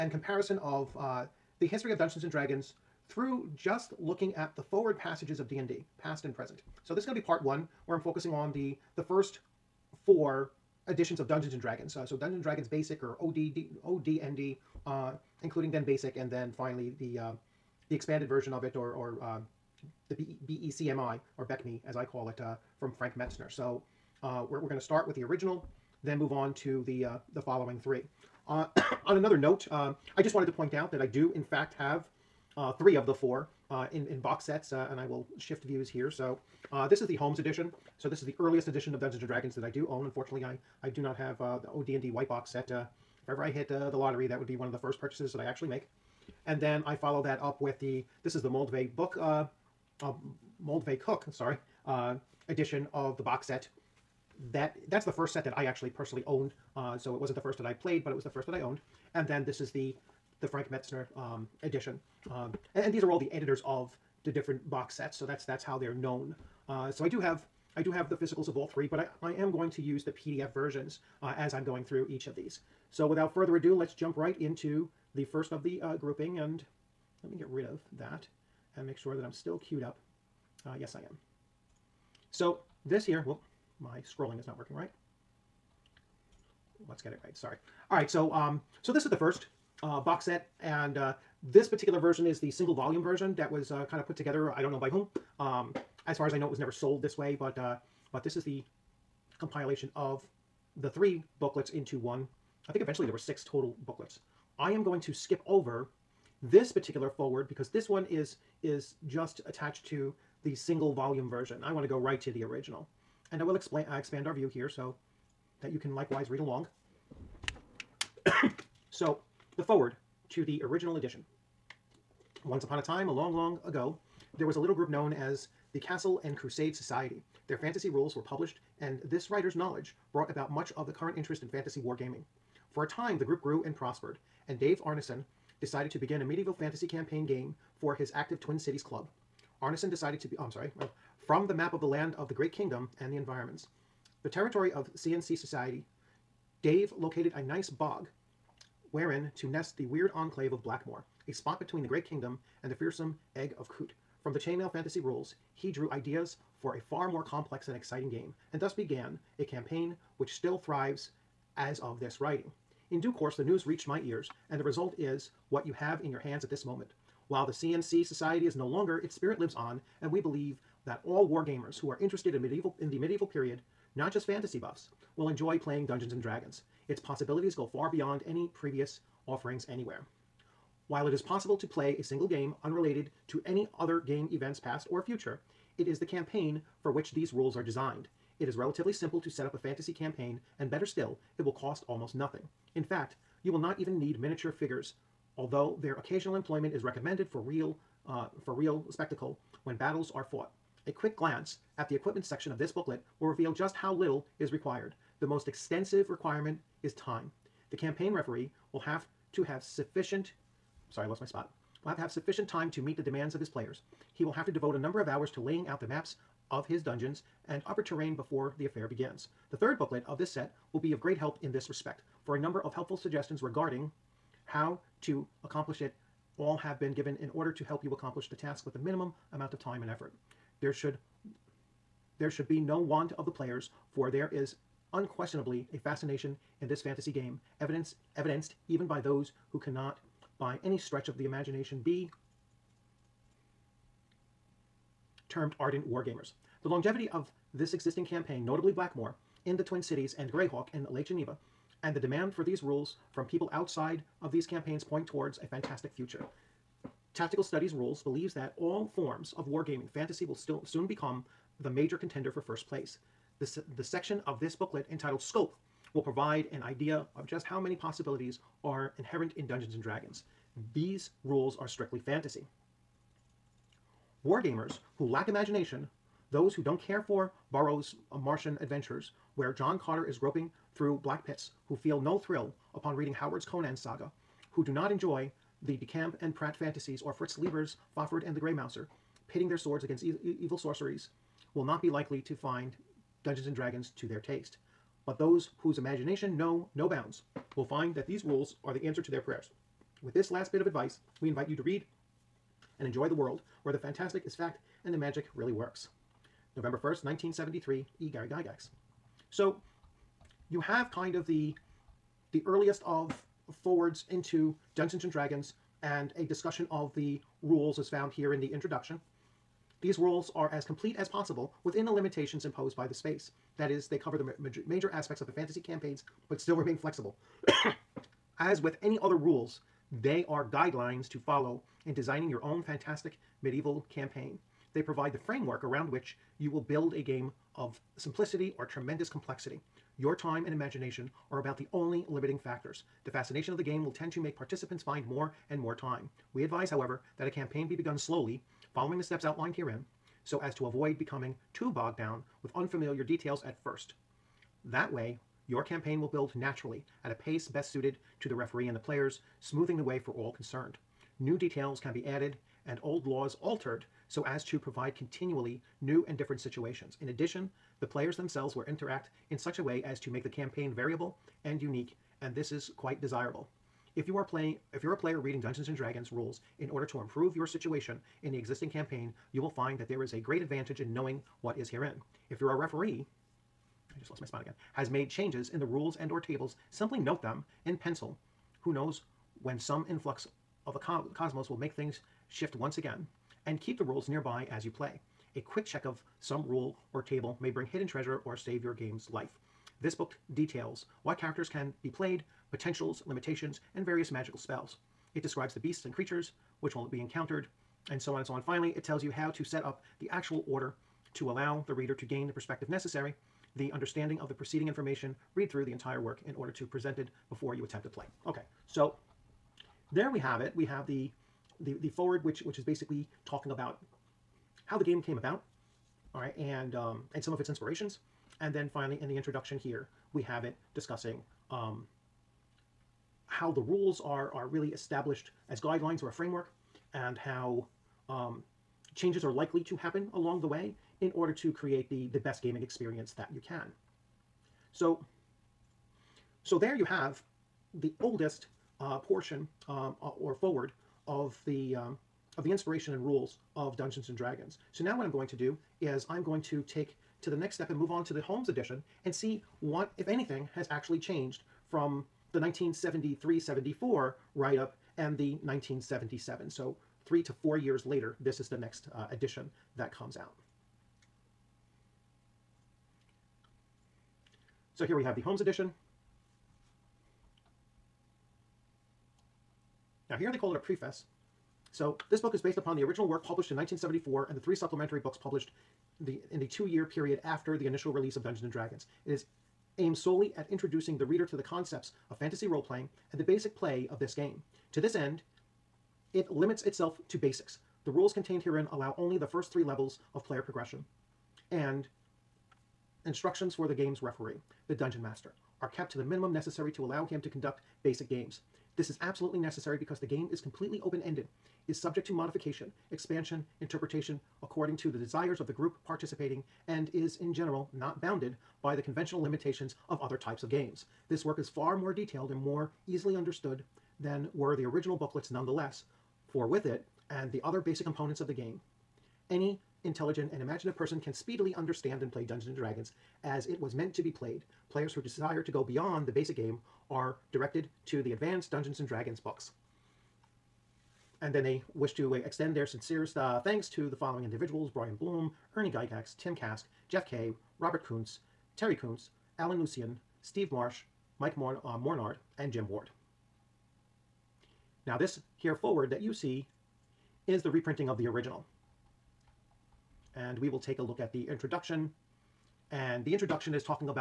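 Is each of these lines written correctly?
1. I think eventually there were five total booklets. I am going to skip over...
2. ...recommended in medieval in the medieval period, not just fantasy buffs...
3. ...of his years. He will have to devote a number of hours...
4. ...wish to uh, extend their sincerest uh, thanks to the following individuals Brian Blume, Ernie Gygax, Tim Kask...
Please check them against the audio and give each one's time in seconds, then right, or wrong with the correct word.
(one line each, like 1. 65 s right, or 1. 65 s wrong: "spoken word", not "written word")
1. 102 s wrong: "six", not "five"
2. 172 s wrong: "interested", not "recommended"
3. 213 s wrong: "players", not "years"
4. 541 s right.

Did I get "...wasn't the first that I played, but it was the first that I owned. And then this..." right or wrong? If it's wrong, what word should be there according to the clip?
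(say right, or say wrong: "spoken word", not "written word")
right.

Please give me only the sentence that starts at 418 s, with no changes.
Okay, so there we have it.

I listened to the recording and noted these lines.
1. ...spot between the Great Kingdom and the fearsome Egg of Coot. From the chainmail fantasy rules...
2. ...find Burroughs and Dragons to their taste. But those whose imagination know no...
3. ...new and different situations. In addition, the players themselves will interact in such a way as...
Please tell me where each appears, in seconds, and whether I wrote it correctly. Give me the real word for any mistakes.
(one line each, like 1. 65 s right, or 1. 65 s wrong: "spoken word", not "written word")
1. 151 s right
2. 292 s wrong: "Dungeons", not "Burroughs"
3. 365 s right.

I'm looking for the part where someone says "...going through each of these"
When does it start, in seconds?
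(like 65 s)
71 s.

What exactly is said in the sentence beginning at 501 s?
And instructions for the game's referee, the dungeon master, are kept to the minimum necessary to allow him to conduct basic games.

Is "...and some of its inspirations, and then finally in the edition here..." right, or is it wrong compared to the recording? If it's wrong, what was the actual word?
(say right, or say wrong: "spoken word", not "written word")
wrong: "introduction", not "edition".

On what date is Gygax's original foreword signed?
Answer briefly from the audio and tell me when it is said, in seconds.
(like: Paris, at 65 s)
November 1st, 1973, at 306 s.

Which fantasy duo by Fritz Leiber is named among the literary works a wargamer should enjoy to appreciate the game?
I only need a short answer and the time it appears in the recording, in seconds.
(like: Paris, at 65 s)
Fafhrd and the Grey Mouser, at 287 s.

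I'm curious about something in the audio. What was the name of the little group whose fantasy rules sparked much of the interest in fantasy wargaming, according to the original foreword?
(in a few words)
Castle and Crusade Society.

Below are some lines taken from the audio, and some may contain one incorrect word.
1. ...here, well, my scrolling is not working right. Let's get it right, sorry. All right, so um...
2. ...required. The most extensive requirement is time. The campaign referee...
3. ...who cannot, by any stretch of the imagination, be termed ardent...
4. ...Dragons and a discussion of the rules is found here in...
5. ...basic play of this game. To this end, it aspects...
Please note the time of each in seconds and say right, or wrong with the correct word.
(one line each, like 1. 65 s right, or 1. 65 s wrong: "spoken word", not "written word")
1. 83 s right
2. 204 s right
3. 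239 s right
4. 315 s right
5. 493 s wrong: "limits", not "aspects".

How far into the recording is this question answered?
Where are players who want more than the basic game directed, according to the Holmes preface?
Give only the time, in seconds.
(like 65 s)
538 s.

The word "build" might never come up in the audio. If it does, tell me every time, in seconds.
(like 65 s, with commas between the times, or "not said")
336 s, 356 s.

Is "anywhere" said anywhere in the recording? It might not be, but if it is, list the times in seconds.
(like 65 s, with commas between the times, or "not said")
179 s.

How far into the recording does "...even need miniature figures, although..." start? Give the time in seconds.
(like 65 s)
193 s.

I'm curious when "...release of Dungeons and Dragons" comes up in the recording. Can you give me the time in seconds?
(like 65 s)
487 s.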